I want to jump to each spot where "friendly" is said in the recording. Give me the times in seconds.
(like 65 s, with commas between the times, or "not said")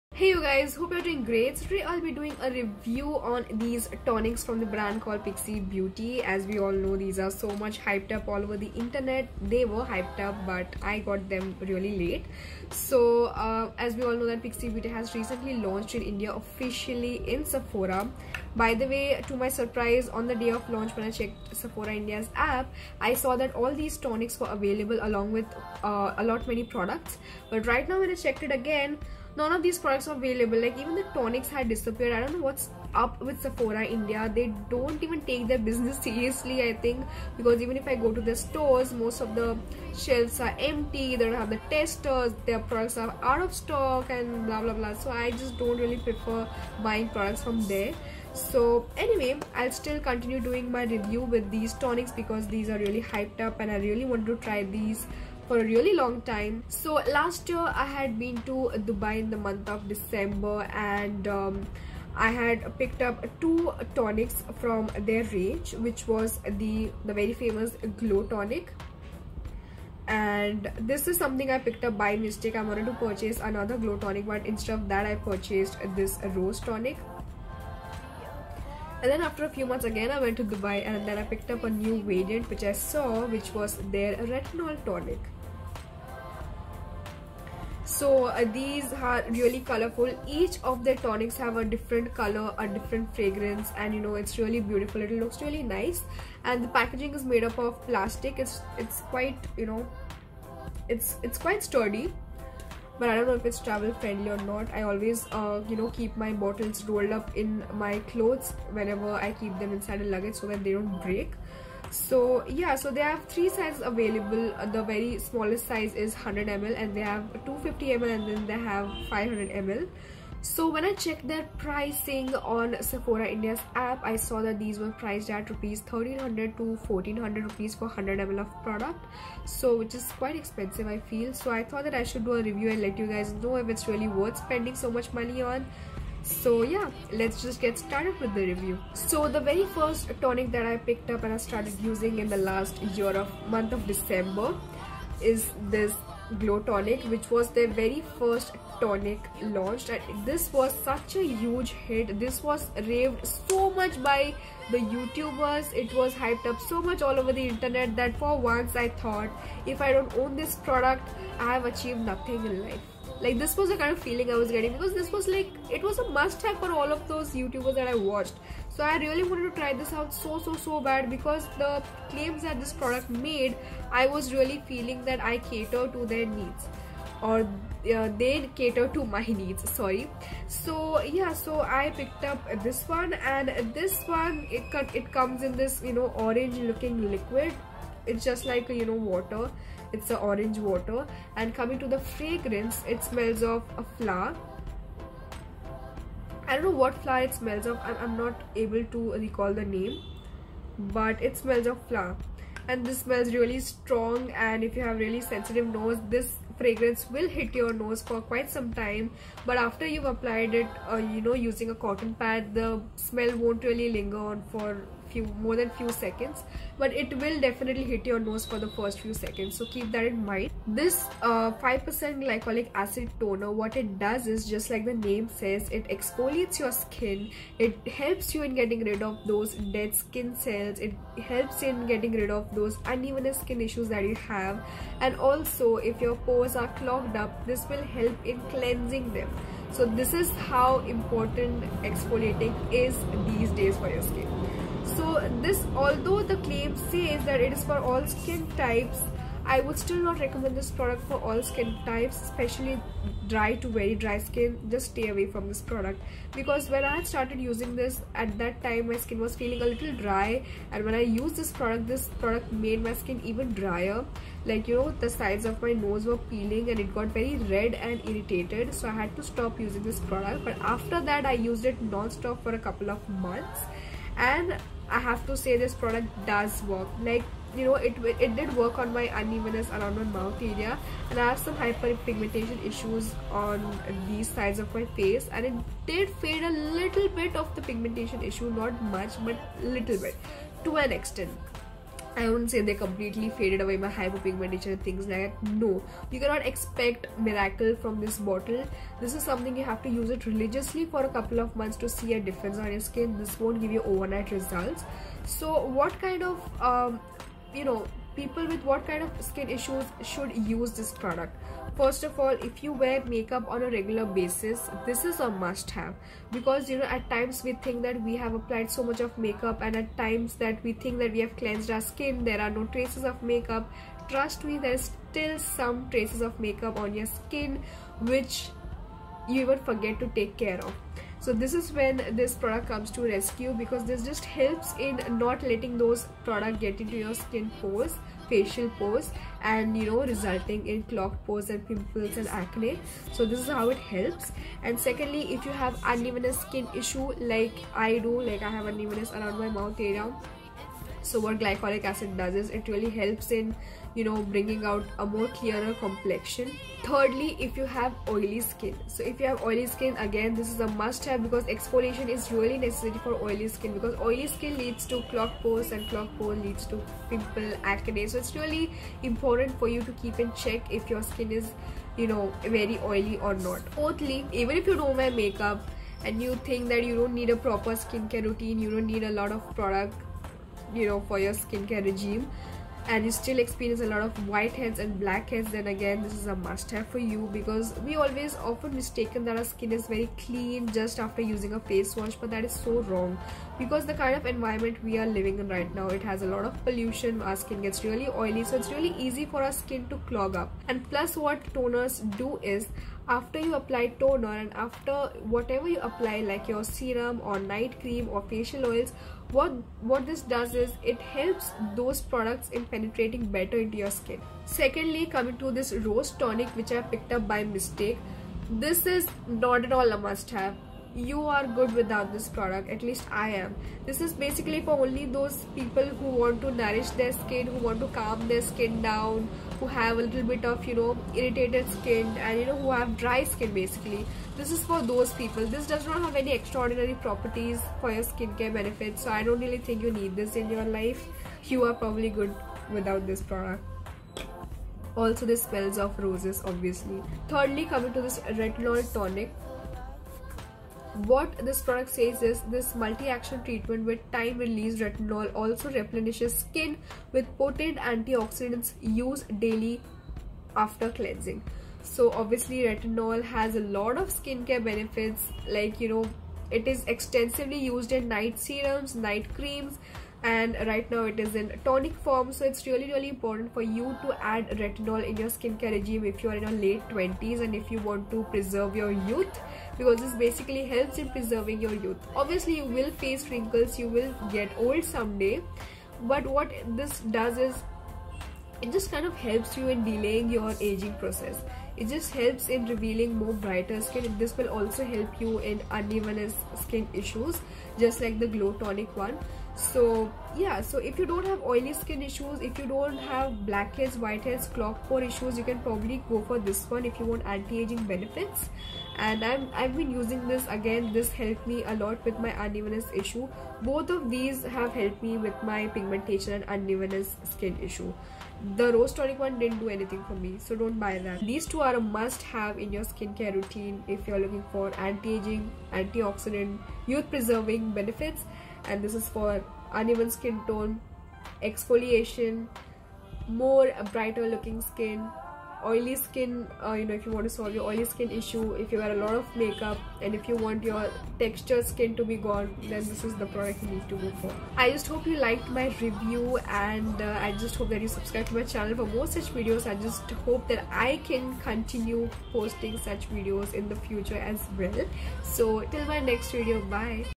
103 s.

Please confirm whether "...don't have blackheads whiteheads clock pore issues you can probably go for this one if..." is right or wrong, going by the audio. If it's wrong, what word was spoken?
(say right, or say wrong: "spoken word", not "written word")
right.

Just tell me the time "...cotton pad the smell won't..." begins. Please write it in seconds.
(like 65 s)
211 s.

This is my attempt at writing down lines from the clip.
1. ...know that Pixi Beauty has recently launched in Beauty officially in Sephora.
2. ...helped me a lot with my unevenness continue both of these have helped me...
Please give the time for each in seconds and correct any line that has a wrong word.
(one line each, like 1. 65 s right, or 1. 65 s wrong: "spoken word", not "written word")
1. 14 s wrong: "India", not "Beauty"
2. 511 s wrong: "issue", not "continue".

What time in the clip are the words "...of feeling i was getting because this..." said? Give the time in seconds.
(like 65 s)
163 s.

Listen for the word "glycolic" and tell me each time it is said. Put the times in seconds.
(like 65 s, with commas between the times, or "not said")
222 s, 351 s.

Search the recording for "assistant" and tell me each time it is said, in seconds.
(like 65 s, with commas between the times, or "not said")
not said.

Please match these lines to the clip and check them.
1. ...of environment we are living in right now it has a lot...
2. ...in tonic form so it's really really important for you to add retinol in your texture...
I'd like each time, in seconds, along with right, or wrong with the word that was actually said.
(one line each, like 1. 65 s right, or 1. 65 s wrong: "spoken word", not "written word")
1. 394 s right
2. 471 s wrong: "skincare", not "texture".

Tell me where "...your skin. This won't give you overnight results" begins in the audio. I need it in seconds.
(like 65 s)
302 s.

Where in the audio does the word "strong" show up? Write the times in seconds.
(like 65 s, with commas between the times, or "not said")
203 s.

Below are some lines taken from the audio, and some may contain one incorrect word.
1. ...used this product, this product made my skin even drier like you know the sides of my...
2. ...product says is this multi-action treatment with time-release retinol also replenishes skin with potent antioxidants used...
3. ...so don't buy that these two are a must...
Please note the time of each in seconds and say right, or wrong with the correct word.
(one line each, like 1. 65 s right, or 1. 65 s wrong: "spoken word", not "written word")
1. 261 s right
2. 451 s right
3. 520 s right.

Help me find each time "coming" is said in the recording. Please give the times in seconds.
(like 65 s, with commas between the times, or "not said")
191 s, 415 s, 447 s.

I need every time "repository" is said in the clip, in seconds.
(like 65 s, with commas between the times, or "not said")
not said.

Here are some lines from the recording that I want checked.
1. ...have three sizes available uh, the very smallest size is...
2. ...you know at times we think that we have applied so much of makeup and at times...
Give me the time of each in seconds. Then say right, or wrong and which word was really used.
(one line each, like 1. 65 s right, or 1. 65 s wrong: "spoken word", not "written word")
1. 113 s right
2. 316 s right.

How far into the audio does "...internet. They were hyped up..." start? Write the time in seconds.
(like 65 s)
8 s.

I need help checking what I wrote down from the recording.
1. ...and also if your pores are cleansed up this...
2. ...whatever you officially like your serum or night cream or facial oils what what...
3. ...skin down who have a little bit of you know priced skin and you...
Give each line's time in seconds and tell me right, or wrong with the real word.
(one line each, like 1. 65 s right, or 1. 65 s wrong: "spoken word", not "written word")
1. 235 s wrong: "clogged", not "cleansed"
2. 405 s wrong: "apply", not "officially"
3. 428 s wrong: "irritated", not "priced".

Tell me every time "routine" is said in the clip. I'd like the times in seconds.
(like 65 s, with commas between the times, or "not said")
378 s, 523 s.